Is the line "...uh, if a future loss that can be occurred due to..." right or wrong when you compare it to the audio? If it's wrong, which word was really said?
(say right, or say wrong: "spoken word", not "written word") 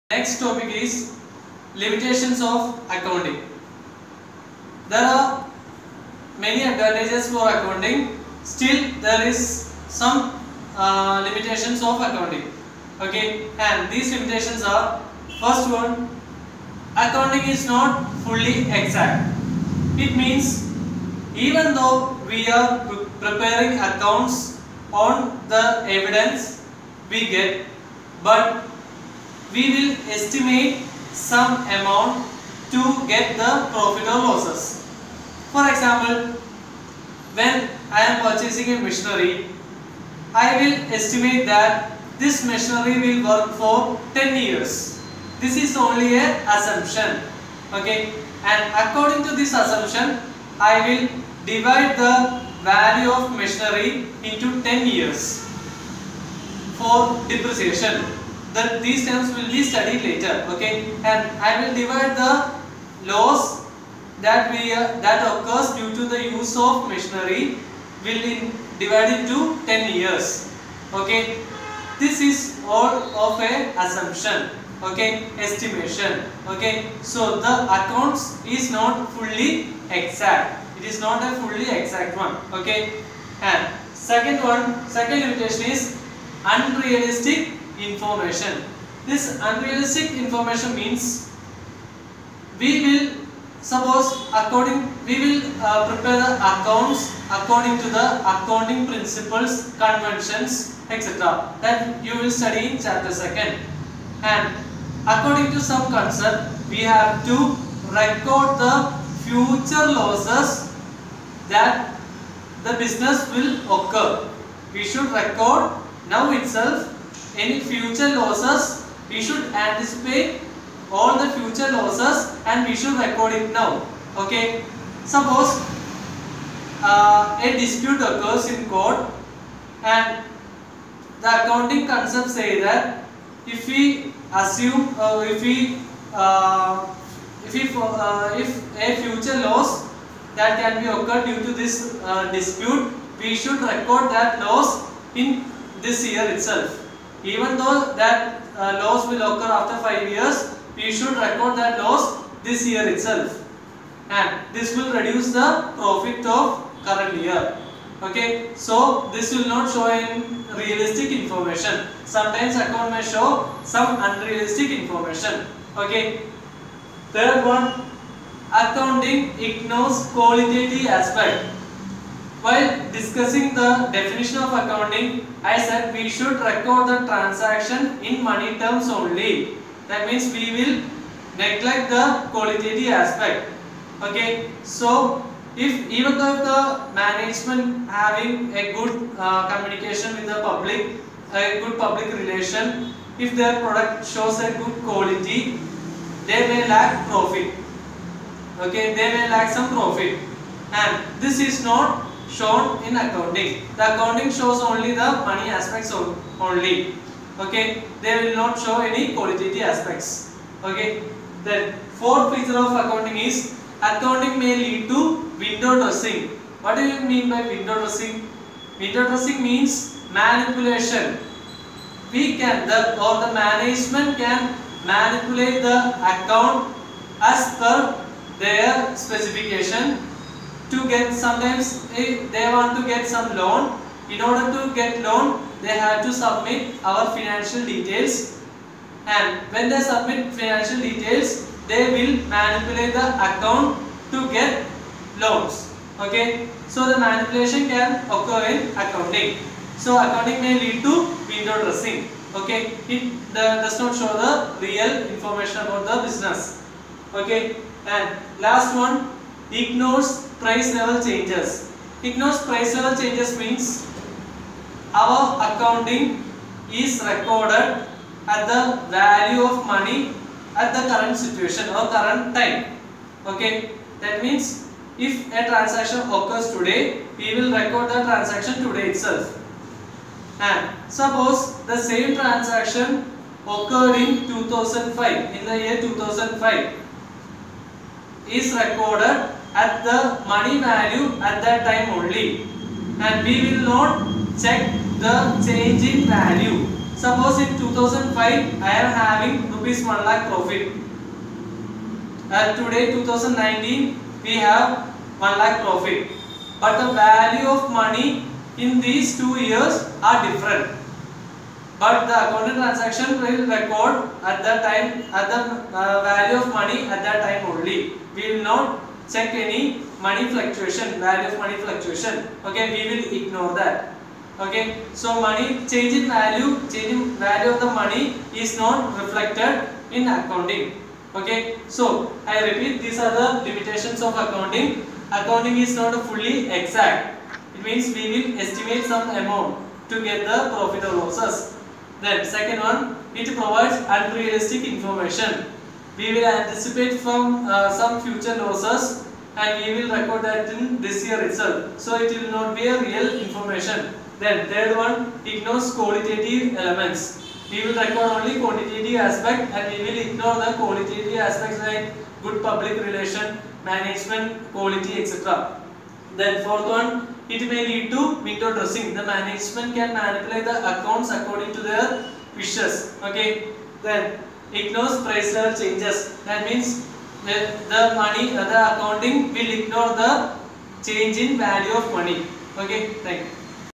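right.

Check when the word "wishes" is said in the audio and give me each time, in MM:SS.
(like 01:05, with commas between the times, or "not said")
06:12.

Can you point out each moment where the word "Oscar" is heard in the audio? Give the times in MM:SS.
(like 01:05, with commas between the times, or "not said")
not said.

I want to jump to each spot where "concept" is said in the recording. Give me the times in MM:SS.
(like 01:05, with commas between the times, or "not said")
01:45, 02:11.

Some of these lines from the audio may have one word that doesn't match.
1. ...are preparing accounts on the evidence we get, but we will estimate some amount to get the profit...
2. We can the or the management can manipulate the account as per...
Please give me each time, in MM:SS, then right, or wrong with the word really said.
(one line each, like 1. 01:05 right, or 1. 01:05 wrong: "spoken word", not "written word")
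1. 00:22 right
2. 03:42 right.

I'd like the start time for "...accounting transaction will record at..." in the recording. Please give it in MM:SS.
05:12.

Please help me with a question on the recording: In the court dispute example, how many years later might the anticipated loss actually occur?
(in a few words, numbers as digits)
5 years.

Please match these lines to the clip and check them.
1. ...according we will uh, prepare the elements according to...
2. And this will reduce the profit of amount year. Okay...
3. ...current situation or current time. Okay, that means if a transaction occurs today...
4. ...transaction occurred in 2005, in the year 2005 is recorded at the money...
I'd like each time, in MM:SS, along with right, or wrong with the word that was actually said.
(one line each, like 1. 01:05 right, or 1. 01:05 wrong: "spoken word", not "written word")
1. 01:34 wrong: "accounts", not "elements"
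2. 02:34 wrong: "current", not "amount"
3. 04:30 right
4. 04:42 right.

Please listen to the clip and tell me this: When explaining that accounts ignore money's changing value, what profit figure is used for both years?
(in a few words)
1 lakh rupees.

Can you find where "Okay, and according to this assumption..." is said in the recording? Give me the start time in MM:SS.
00:47.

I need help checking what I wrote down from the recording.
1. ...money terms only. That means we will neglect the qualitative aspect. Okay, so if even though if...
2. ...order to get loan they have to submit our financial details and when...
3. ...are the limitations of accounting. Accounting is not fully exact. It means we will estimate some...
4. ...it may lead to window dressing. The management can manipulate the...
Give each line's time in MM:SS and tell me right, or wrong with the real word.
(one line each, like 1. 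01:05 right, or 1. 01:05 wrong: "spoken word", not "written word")
1. 02:58 right
2. 03:54 right
3. 05:32 right
4. 06:07 right.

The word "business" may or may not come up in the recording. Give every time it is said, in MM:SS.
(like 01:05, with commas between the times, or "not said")
01:52, 04:16.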